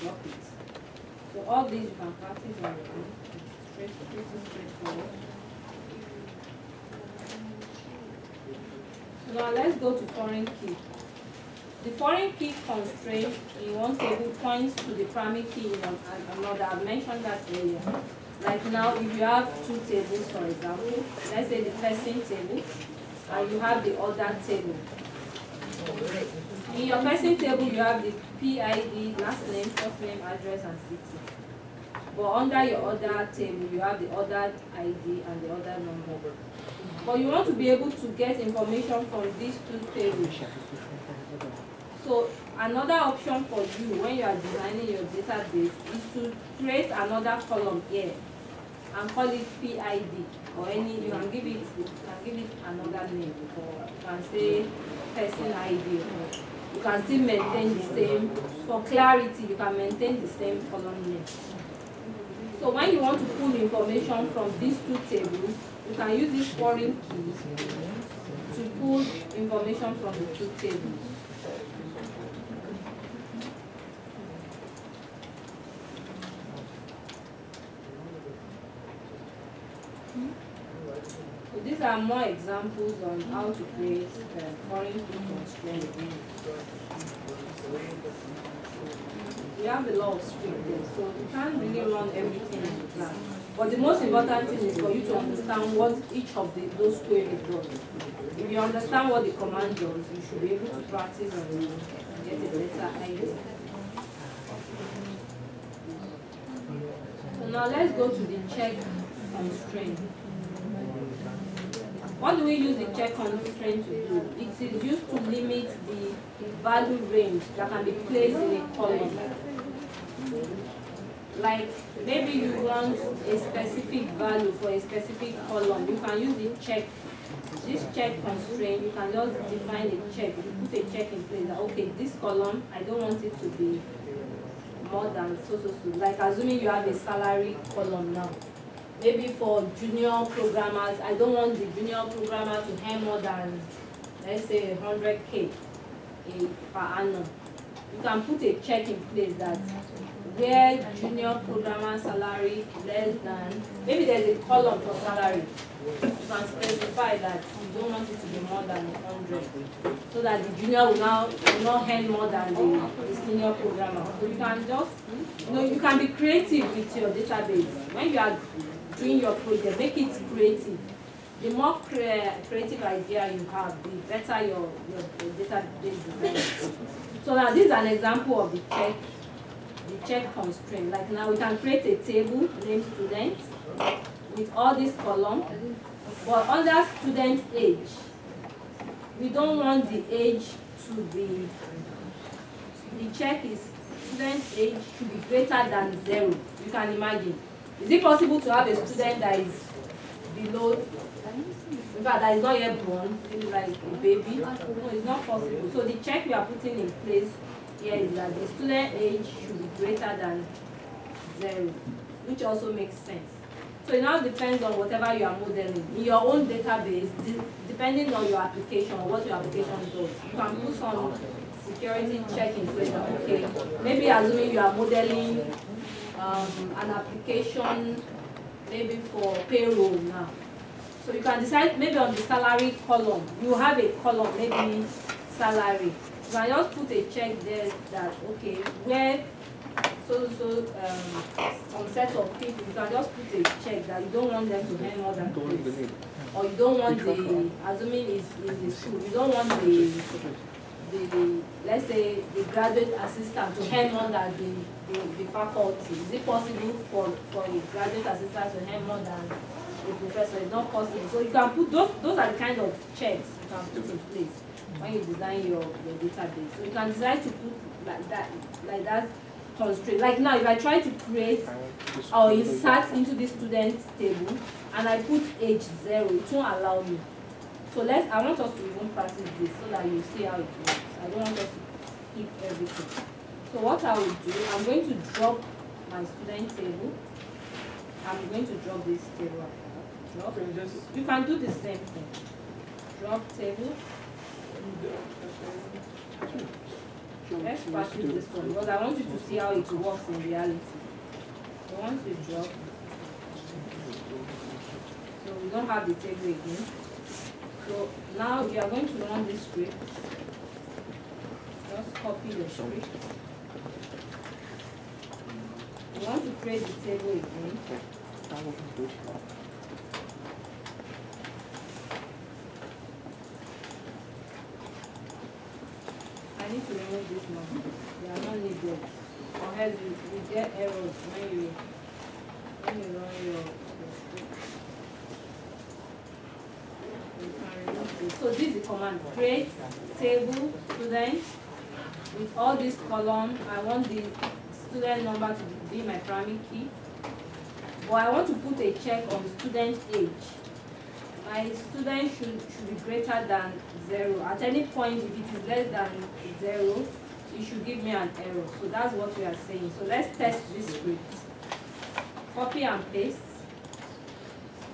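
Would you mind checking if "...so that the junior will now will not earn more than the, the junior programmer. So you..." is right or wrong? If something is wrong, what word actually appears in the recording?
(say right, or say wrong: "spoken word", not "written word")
wrong: "senior", not "junior".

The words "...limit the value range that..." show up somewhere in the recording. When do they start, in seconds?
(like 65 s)
115 s.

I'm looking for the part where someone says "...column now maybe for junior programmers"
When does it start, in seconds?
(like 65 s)
137 s.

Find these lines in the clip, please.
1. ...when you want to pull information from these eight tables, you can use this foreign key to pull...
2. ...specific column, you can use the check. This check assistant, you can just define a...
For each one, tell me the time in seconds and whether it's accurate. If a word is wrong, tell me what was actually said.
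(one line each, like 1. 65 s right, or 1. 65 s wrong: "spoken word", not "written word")
1. 62 s wrong: "two", not "eight"
2. 124 s wrong: "constraint", not "assistant".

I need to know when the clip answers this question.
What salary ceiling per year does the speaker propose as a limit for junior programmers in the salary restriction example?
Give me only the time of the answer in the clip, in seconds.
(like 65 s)
144 s.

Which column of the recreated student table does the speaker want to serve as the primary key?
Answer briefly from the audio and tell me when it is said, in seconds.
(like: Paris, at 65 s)
student number, at 344 s.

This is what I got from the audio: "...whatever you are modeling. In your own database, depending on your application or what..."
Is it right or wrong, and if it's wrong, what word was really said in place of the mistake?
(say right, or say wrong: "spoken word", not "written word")
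right.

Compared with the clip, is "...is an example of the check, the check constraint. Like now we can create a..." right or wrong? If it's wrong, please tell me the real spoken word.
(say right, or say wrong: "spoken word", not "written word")
right.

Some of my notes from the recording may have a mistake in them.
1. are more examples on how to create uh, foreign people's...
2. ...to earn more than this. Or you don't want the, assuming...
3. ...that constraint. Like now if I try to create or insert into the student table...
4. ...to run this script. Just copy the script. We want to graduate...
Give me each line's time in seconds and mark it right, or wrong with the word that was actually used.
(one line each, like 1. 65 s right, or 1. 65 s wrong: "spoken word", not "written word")
1. 81 s right
2. 244 s right
3. 268 s right
4. 308 s wrong: "create", not "graduate".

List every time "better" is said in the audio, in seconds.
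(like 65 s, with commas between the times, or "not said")
102 s, 174 s.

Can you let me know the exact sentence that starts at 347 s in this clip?
But I want to put a check on the student age.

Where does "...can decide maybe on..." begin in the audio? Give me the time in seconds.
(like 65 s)
231 s.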